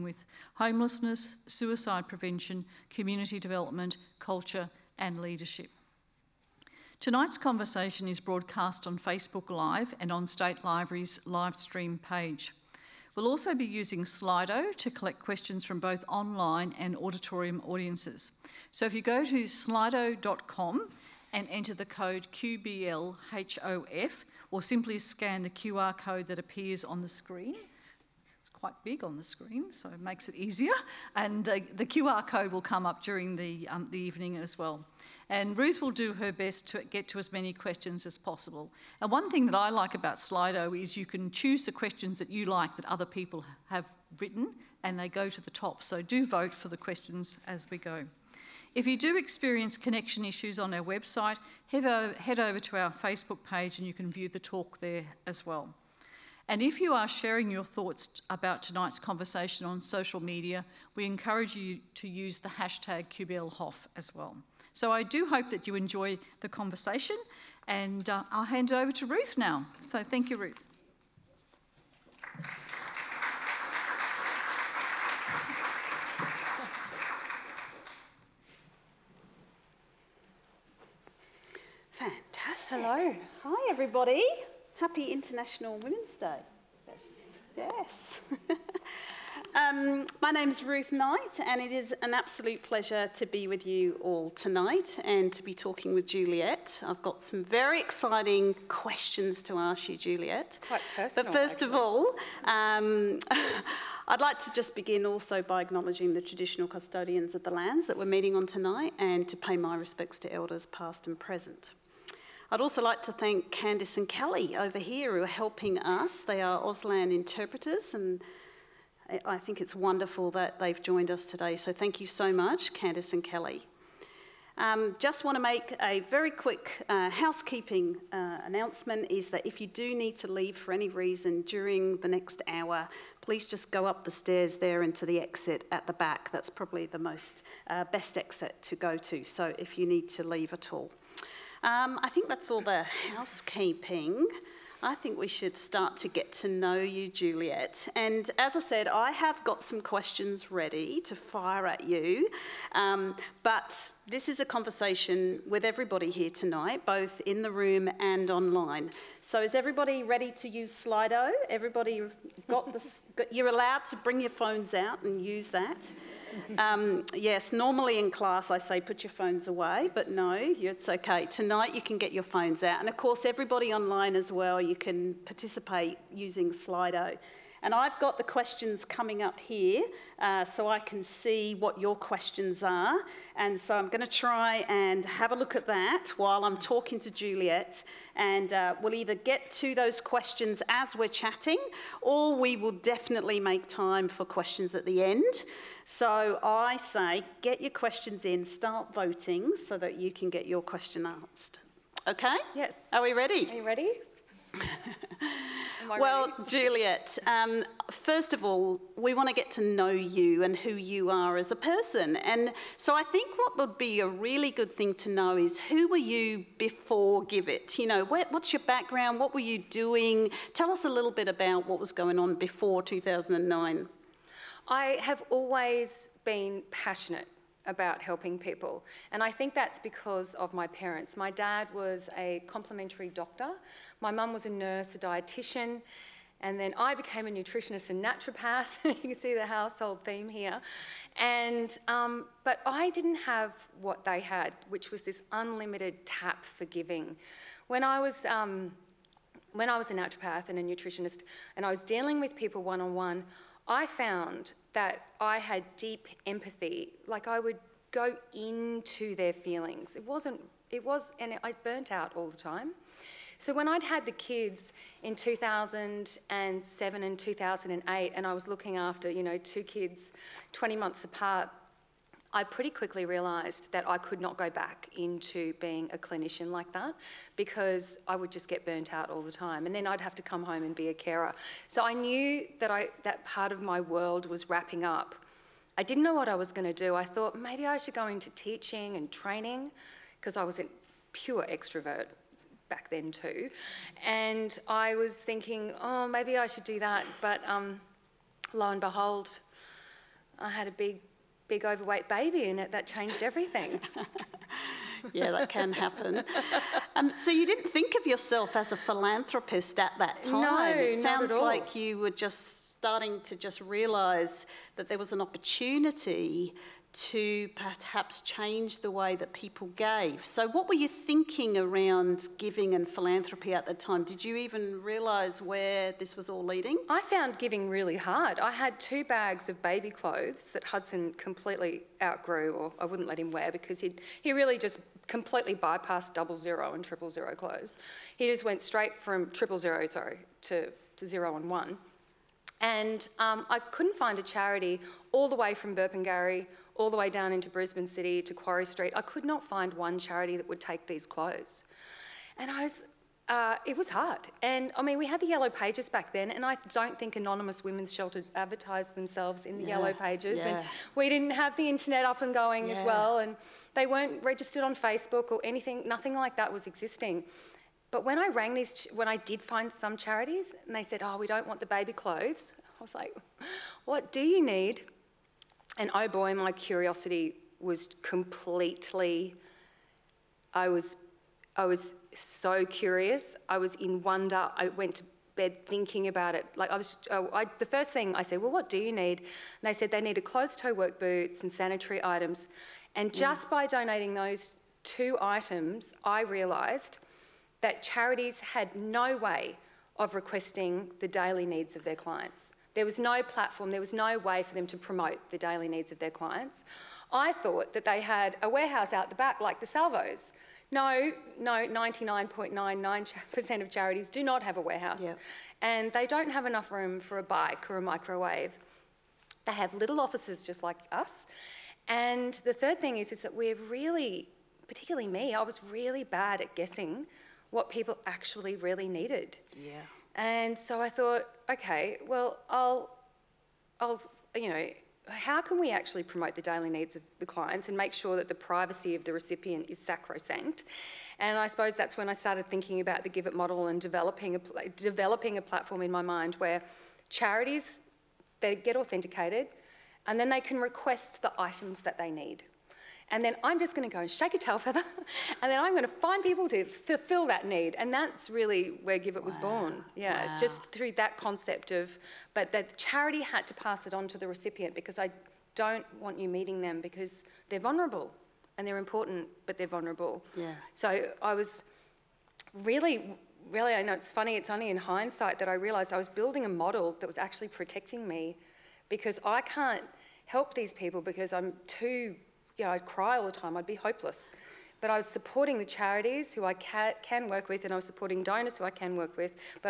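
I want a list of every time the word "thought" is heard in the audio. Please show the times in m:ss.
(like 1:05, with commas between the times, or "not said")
0:57, 4:47, 6:47, 7:10.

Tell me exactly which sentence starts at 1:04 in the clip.
So I do hope that you enjoy the conversation and uh, I'll hand it over to Ruth now.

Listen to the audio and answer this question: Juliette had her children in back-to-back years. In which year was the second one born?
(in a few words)
2008.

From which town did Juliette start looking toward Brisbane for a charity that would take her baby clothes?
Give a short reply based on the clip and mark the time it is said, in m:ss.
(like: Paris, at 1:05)
Burpengary, at 5:45.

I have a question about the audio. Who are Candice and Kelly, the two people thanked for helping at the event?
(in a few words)
Auslan interpreters.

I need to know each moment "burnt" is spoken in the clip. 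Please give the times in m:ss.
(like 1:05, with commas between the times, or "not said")
4:21, 4:38.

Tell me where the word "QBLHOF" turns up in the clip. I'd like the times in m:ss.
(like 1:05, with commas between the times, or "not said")
0:22, 1:03.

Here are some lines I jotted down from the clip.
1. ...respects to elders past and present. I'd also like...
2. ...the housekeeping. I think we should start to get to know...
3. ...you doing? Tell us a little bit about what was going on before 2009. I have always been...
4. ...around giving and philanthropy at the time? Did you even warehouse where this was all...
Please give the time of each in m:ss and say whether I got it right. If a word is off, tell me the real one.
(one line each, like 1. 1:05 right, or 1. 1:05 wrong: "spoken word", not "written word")
1. 1:49 right
2. 2:22 right
3. 3:39 right
4. 5:21 wrong: "realise", not "warehouse".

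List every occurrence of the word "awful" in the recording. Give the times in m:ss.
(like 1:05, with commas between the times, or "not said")
not said.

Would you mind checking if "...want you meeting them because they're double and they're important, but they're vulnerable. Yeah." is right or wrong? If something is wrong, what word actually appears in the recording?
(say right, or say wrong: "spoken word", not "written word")
wrong: "vulnerable", not "double".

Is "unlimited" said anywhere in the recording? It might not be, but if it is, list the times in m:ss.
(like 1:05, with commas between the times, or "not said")
4:05.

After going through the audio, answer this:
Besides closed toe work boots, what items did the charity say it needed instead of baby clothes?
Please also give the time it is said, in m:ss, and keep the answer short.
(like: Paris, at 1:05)
Sanitary items, at 6:31.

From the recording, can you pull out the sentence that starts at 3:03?
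And so I'm going to try and have a look at that while I'm talking to Juliette.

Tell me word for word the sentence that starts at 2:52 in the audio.
And of course, everybody online as well, you can participate using Slido.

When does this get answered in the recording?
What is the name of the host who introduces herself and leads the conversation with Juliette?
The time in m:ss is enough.
1:30.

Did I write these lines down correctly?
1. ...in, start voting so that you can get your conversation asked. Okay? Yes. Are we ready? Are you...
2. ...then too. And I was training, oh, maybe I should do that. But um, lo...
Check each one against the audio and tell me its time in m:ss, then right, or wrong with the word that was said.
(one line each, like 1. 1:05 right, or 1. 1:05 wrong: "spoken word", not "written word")
1. 3:18 wrong: "question", not "conversation"
2. 4:52 wrong: "thinking", not "training".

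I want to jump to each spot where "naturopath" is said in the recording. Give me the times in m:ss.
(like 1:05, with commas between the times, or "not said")
3:58, 4:09.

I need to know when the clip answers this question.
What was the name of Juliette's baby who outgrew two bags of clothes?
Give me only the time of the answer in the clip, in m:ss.
5:30.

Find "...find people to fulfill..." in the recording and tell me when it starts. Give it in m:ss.
7:35.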